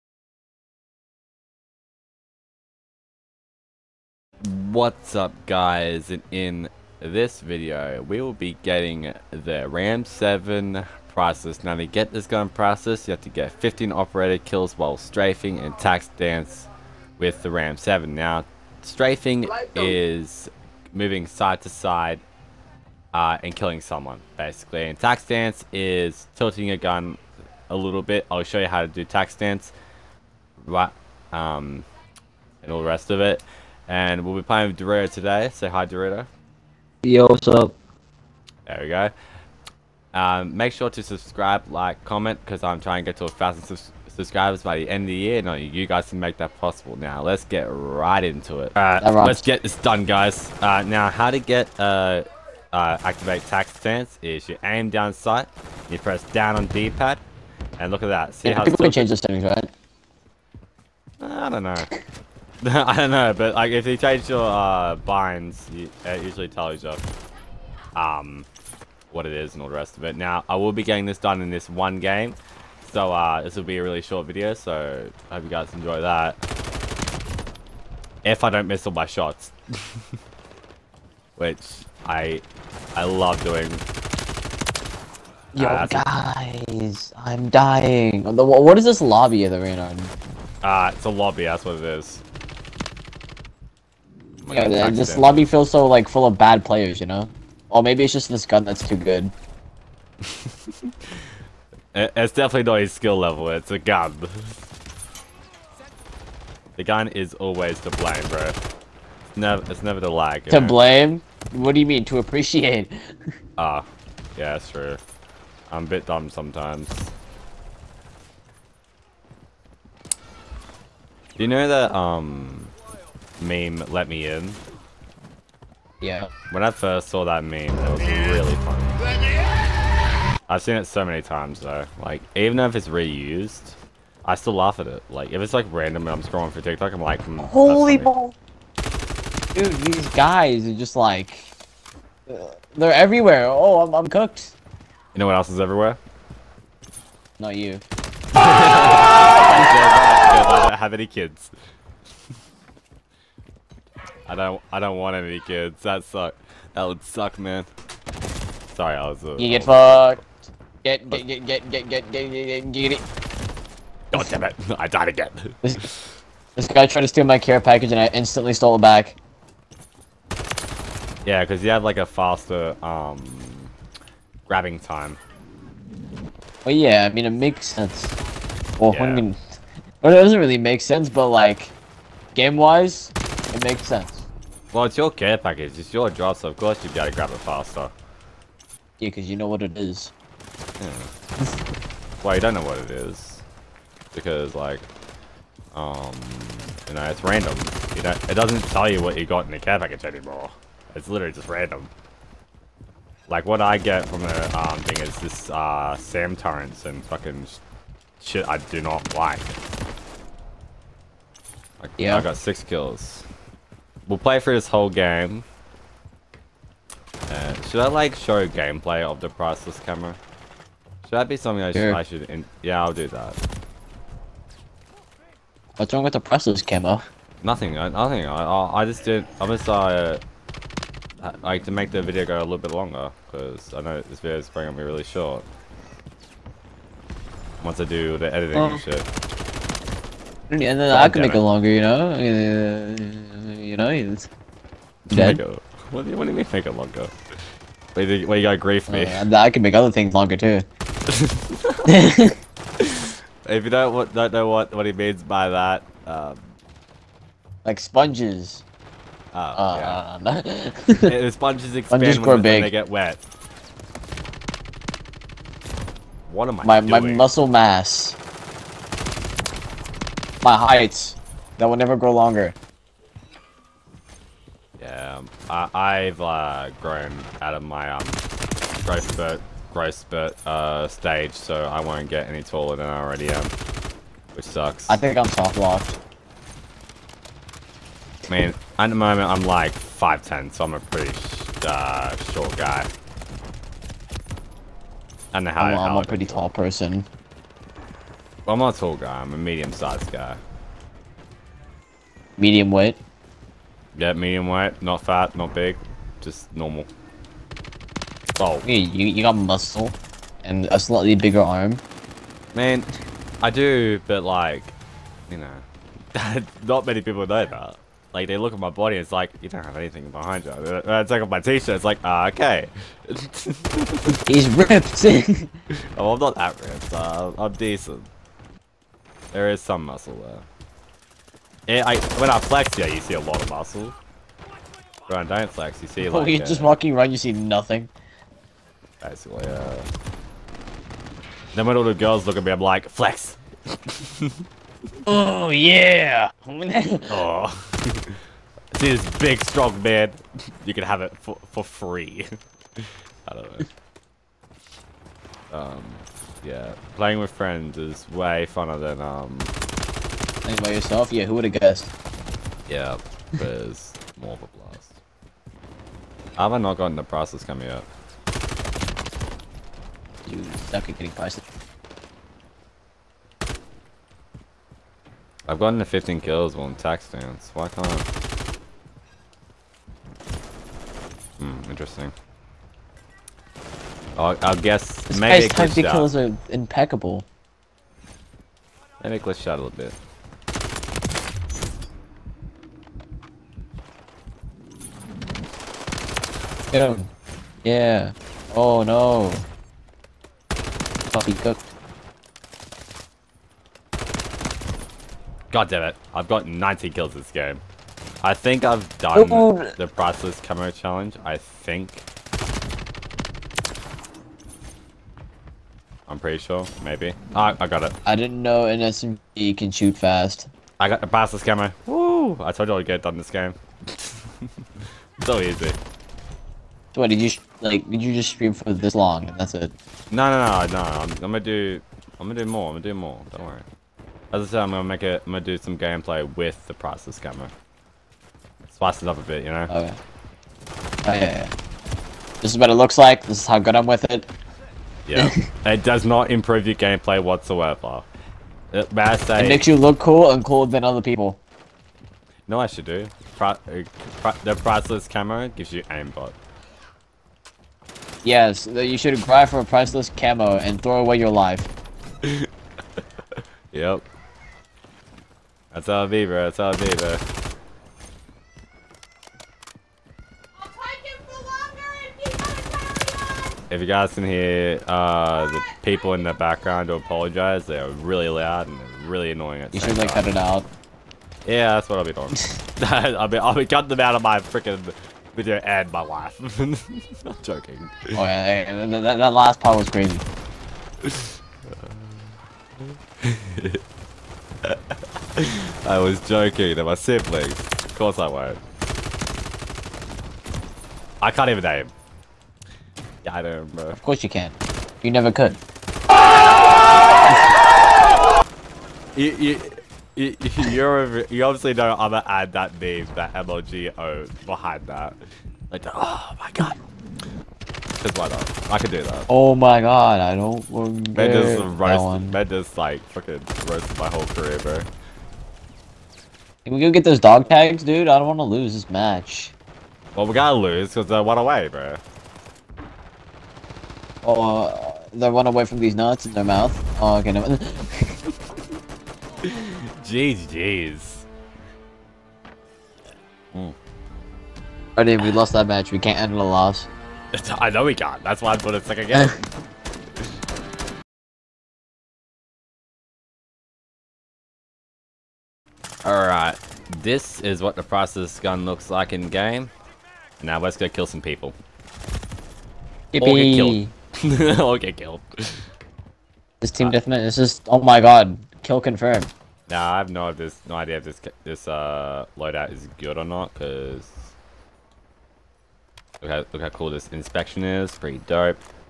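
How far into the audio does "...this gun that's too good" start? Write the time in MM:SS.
01:38.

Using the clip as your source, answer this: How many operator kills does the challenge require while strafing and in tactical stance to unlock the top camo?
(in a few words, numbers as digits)
15.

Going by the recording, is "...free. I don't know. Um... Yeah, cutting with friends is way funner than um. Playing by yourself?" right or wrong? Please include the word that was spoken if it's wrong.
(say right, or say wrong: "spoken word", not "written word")
wrong: "playing", not "cutting".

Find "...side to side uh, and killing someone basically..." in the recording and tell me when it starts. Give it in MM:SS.
00:21.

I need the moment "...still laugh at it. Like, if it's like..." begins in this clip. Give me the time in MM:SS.
02:14.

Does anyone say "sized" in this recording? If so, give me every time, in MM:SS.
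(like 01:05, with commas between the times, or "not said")
04:59.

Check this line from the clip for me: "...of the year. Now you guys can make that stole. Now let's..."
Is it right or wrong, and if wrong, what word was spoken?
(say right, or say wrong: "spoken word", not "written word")
wrong: "possible", not "stole".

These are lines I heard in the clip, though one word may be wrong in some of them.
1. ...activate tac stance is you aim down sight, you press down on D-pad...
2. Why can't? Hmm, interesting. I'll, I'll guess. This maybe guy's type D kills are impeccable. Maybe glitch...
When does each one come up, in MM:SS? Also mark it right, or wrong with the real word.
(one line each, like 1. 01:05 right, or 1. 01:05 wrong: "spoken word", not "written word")
1. 00:53 right
2. 06:17 right.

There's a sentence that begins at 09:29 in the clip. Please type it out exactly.
Nah, I have no, this, no idea if this this uh loadout is good or not.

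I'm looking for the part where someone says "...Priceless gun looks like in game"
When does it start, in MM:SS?
09:17.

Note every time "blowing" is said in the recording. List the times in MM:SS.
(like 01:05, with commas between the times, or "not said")
not said.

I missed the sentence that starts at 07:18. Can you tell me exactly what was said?
Spice it up a bit, you know.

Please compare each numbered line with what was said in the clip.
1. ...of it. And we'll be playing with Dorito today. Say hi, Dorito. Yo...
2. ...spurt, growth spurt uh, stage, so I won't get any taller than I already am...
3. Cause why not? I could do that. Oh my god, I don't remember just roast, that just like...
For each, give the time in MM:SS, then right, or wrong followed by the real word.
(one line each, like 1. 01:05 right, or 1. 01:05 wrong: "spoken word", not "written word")
1. 00:33 right
2. 04:39 right
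3. 08:38 right.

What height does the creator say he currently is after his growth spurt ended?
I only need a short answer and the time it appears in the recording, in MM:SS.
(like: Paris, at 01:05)
5'10", at 04:49.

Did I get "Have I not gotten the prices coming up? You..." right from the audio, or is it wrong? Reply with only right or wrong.
right.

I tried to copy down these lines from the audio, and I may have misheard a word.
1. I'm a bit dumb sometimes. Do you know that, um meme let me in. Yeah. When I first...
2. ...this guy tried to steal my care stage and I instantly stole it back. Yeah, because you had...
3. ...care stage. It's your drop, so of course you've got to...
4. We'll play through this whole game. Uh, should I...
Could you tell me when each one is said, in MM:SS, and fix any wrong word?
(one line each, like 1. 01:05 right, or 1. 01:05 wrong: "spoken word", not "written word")
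1. 01:55 right
2. 02:46 wrong: "package", not "stage"
3. 03:05 wrong: "package", not "stage"
4. 03:34 right.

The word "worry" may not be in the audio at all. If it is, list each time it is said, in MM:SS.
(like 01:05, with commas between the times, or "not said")
07:13.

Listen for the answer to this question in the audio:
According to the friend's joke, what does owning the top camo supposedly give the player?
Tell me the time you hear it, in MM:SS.
07:35.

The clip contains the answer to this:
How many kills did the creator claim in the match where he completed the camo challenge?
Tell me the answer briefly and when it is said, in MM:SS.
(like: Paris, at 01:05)
90, at 06:46.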